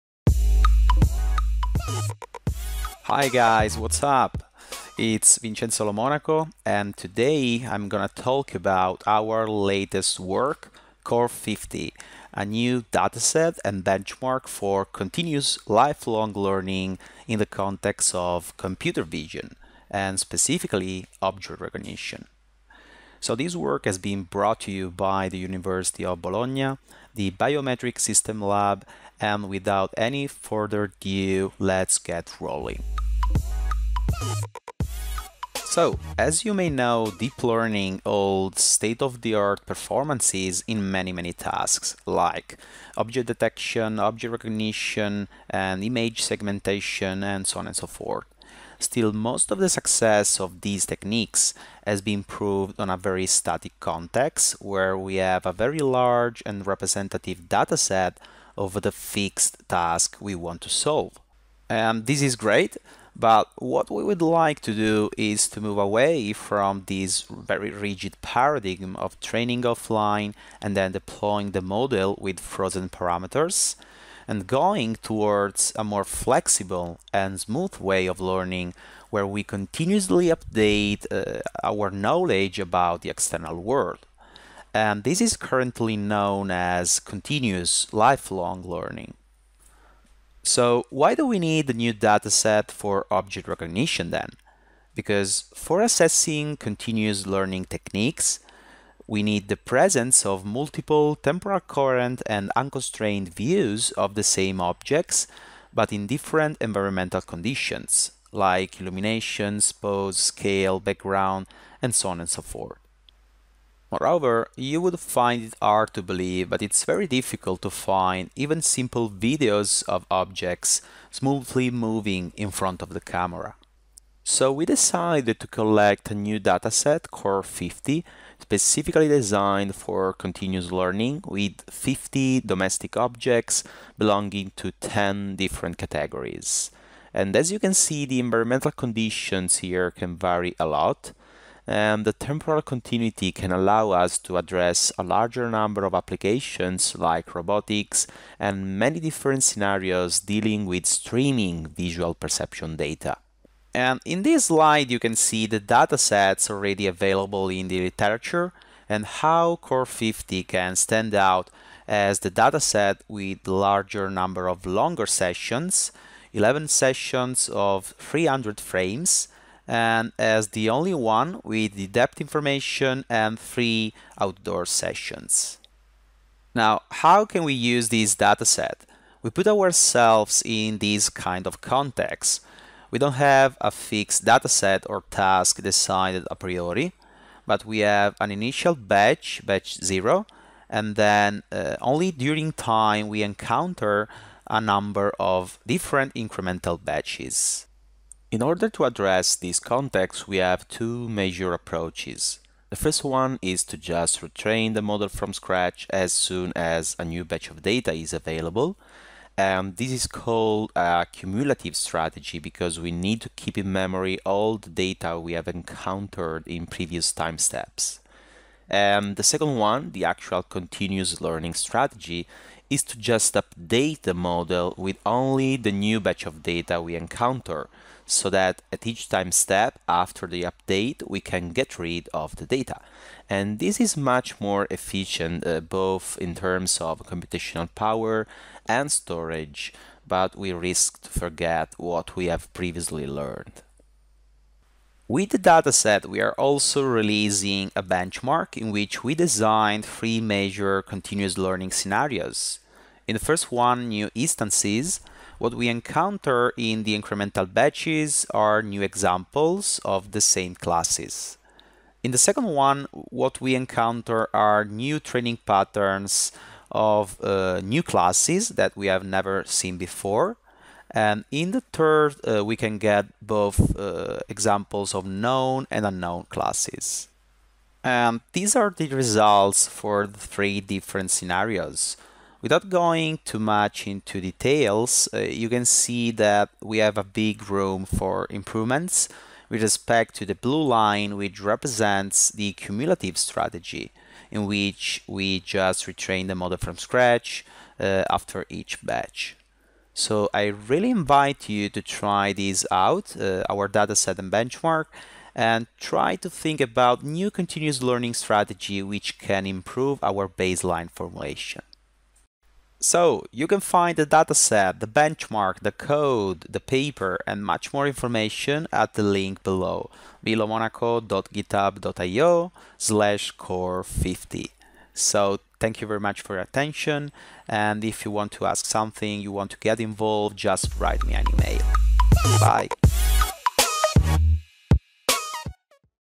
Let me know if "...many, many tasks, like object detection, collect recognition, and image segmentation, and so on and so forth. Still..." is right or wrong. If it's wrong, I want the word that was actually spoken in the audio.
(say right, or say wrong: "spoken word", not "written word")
wrong: "object", not "collect".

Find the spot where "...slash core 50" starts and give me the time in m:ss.
5:22.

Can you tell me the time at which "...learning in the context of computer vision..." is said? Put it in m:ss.
0:16.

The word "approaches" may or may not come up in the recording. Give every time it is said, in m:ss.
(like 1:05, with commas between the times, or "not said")
3:21.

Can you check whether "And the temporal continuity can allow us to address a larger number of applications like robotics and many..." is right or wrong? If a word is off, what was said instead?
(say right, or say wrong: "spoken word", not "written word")
right.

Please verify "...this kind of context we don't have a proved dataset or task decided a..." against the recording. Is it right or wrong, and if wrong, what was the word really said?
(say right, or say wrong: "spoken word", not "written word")
wrong: "fixed", not "proved".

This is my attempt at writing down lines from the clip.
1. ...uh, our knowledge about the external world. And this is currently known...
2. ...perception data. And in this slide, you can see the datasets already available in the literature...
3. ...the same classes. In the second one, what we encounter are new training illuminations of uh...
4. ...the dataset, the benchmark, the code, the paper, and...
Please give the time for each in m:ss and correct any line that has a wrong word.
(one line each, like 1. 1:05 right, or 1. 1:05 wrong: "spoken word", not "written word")
1. 1:21 right
2. 2:32 right
3. 4:20 wrong: "patterns", not "illuminations"
4. 5:13 right.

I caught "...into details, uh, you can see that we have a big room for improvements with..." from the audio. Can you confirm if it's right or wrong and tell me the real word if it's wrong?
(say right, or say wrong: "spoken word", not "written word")
right.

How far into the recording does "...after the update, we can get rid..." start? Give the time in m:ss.
3:49.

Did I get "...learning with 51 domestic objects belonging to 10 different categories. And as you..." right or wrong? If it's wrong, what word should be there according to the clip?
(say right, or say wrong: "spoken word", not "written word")
wrong: "50", not "51".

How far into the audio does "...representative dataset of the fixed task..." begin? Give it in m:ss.
0:56.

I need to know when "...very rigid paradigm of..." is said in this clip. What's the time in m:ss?
1:07.